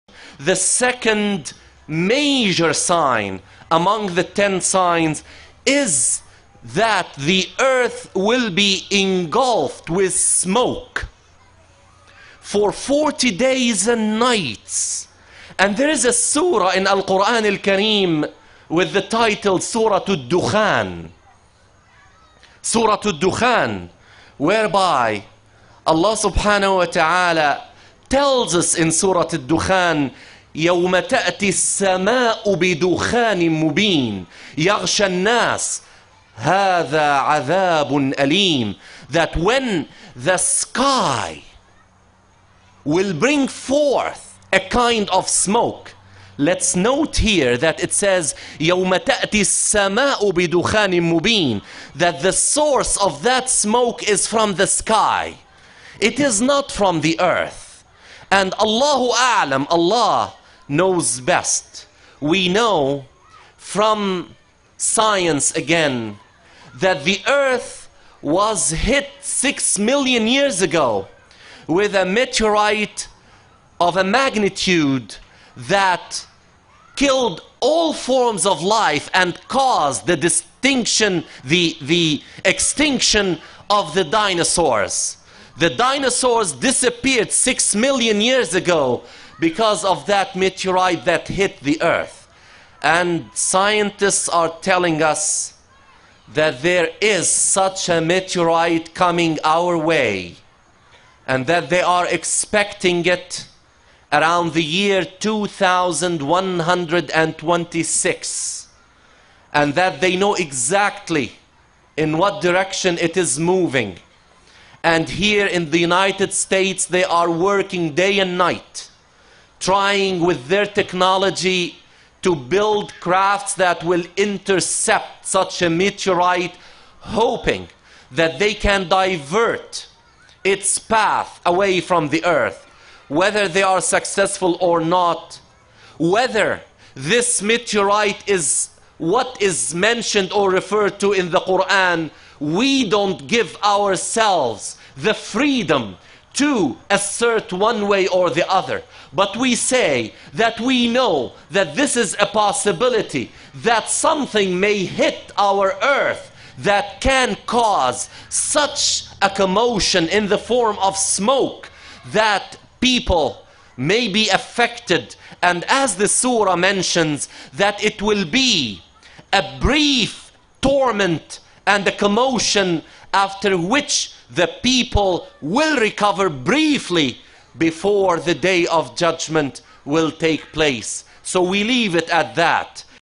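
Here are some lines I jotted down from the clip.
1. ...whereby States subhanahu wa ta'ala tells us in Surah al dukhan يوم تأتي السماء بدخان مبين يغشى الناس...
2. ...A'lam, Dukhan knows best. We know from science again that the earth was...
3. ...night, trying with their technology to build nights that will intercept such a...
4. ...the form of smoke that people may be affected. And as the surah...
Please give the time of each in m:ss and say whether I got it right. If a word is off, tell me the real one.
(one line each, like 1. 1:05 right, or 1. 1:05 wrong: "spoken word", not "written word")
1. 0:24 wrong: "Allah", not "States"
2. 0:59 wrong: "Allah", not "Dukhan"
3. 1:58 wrong: "crafts", not "nights"
4. 2:40 right.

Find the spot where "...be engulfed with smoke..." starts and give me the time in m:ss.
0:08.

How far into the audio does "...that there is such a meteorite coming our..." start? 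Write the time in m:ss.
1:36.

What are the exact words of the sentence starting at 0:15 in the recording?
And there is a surah in Al Quran Al Kareem with the title Surah Al Dukhan.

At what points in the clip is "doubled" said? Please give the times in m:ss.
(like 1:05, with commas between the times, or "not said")
not said.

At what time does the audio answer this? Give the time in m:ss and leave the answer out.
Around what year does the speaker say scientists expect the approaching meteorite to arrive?
1:45.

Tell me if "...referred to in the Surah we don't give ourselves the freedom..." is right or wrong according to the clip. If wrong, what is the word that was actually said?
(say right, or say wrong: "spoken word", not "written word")
wrong: "Quran", not "Surah".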